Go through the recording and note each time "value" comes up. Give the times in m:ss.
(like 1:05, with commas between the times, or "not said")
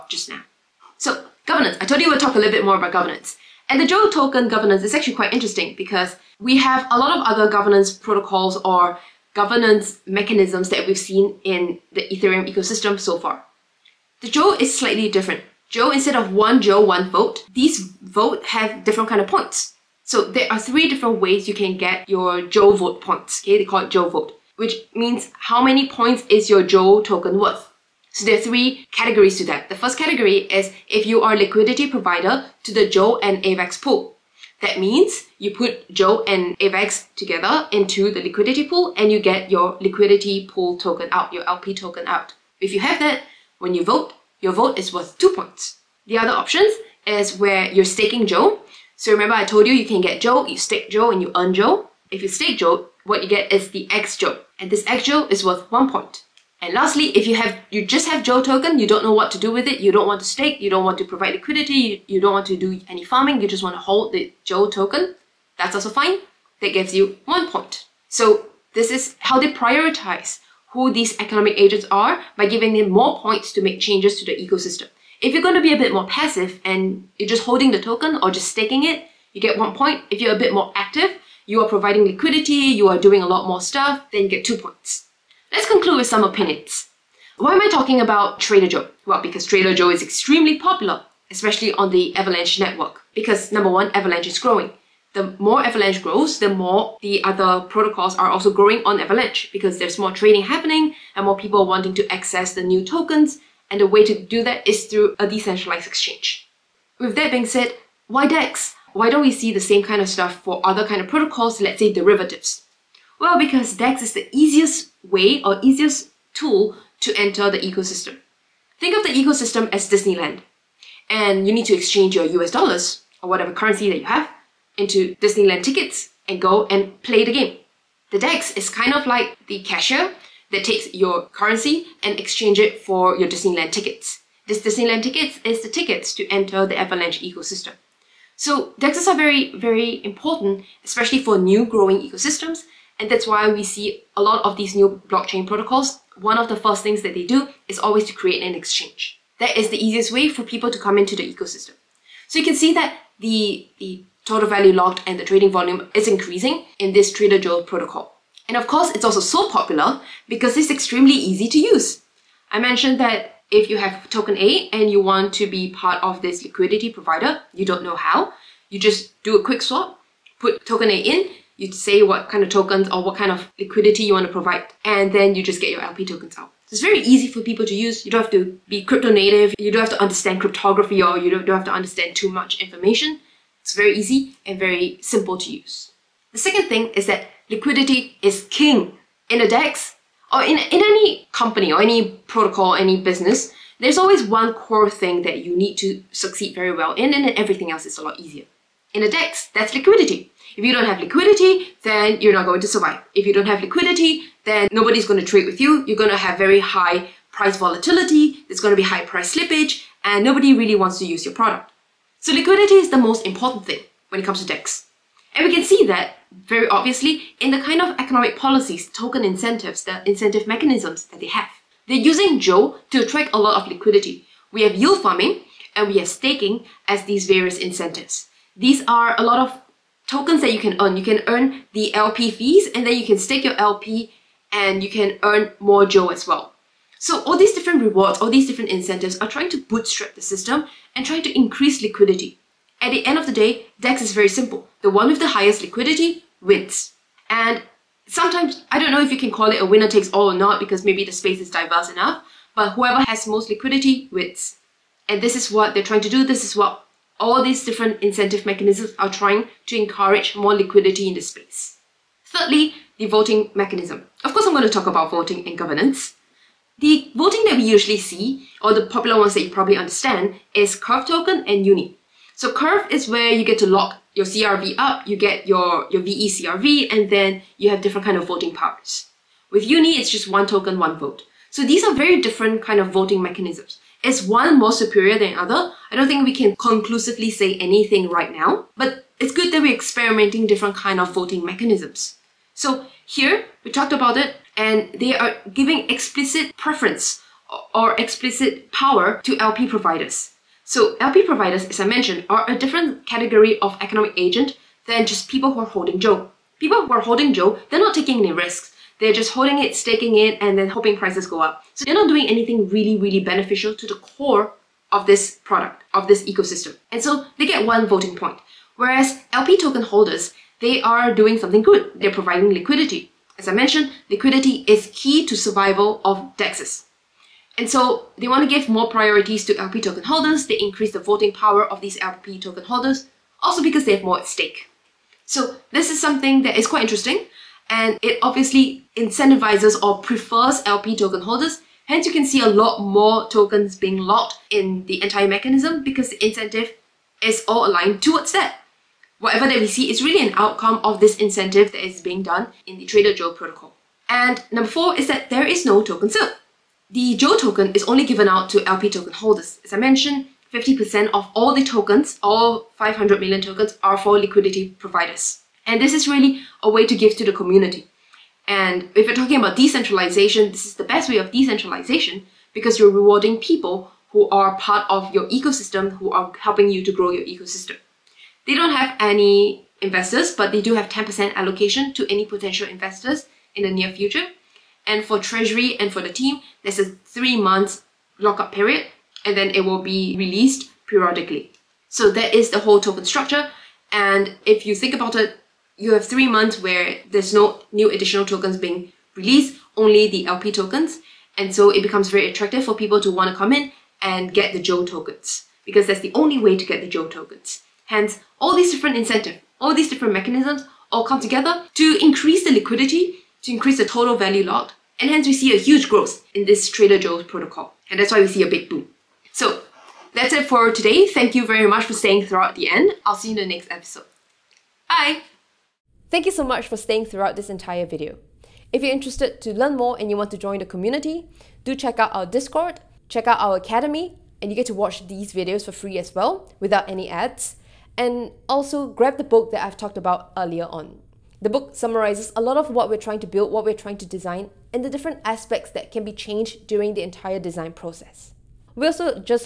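2:34, 6:54.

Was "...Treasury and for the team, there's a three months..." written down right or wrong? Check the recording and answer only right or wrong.
right.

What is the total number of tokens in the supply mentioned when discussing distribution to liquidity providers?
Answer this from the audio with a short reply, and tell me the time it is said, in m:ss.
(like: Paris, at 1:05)
500 million, at 6:02.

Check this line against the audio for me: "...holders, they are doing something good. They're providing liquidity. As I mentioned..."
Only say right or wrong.
right.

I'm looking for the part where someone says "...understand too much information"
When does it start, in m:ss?
3:01.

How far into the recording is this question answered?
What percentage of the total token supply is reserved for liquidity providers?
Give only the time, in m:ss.
6:00.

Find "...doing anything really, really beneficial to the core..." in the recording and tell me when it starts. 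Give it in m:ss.
5:12.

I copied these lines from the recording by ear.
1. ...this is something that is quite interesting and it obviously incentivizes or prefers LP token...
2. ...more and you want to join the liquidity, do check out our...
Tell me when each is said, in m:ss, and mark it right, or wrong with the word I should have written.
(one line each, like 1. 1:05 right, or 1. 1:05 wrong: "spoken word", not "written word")
1. 5:35 right
2. 7:09 wrong: "community", not "liquidity".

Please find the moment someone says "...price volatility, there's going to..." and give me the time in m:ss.
3:27.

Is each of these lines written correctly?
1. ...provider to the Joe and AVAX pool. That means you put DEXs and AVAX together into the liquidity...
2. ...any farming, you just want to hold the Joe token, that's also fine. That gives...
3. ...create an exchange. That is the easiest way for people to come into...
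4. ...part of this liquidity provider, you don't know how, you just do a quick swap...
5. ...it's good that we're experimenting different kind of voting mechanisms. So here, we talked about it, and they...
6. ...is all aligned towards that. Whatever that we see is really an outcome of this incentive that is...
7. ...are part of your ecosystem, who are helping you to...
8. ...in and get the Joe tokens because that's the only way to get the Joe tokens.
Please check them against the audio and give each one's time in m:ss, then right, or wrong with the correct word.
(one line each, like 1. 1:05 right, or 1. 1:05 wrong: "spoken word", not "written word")
1. 0:31 wrong: "Joe", not "DEXs"
2. 1:02 right
3. 2:28 right
4. 2:45 right
5. 4:49 right
6. 5:47 right
7. 6:14 right
8. 6:43 right.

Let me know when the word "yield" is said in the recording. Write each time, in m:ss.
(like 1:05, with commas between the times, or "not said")
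3:44.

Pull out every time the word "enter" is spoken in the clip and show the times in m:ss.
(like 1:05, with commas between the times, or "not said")
1:57, 2:16.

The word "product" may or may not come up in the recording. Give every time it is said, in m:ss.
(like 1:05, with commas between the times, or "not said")
3:31, 5:15.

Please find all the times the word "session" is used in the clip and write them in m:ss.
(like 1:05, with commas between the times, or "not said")
not said.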